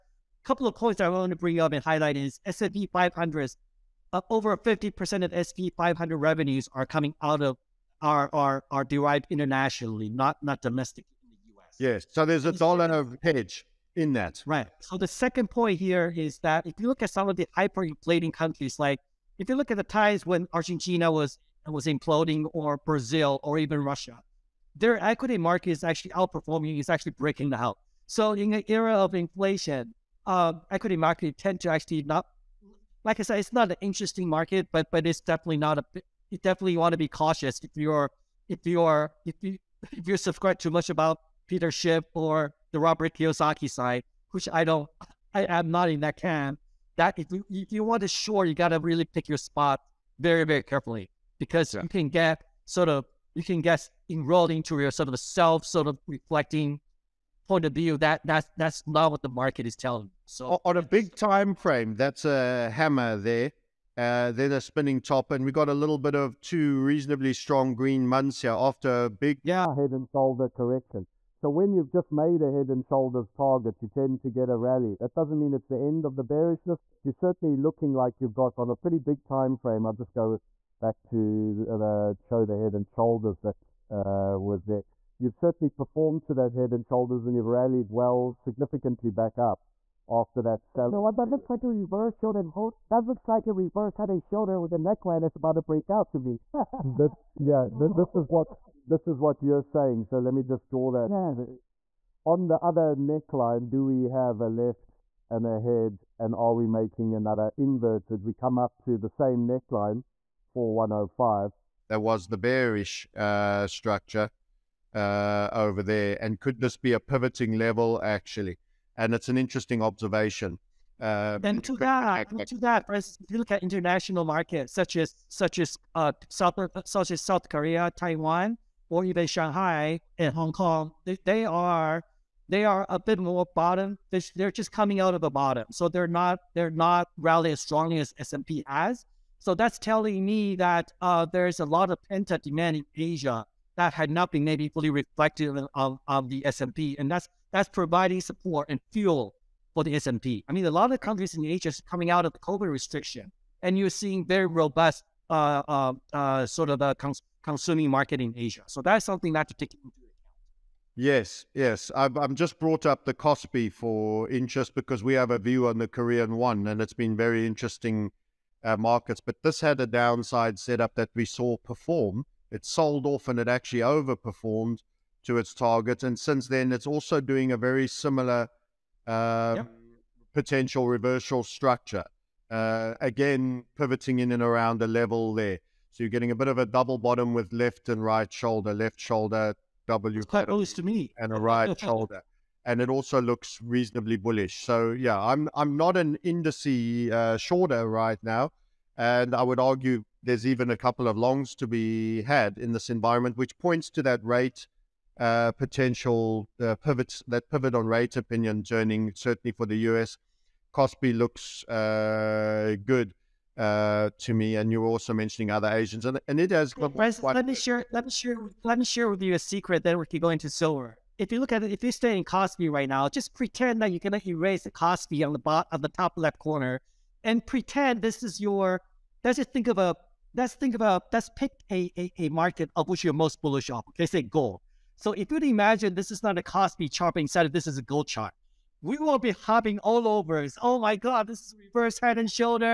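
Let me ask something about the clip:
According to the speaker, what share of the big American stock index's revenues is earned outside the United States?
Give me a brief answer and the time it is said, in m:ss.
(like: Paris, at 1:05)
over 50%, at 0:04.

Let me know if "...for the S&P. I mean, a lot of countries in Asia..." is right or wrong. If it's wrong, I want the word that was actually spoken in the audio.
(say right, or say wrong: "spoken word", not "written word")
right.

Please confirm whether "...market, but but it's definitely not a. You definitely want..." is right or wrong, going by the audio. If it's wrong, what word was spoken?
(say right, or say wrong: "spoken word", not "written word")
right.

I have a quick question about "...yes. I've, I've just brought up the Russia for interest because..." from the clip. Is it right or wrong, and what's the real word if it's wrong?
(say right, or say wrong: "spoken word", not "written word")
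wrong: "Kospi", not "Russia".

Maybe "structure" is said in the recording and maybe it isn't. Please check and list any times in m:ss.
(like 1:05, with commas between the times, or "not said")
1:53, 3:01.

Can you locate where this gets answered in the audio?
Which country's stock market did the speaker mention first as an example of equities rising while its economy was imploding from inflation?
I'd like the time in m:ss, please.
0:20.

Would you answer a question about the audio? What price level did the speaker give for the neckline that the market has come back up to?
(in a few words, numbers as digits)
105.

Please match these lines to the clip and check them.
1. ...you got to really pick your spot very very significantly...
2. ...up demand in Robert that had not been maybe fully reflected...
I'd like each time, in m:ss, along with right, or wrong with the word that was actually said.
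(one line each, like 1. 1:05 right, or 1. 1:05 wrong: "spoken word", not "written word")
1. 0:48 wrong: "carefully", not "significantly"
2. 2:22 wrong: "Asia", not "Robert".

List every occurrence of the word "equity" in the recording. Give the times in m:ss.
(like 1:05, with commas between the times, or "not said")
0:25, 0:30.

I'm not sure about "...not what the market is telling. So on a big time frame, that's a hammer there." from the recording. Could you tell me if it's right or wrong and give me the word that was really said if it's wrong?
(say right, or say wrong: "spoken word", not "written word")
right.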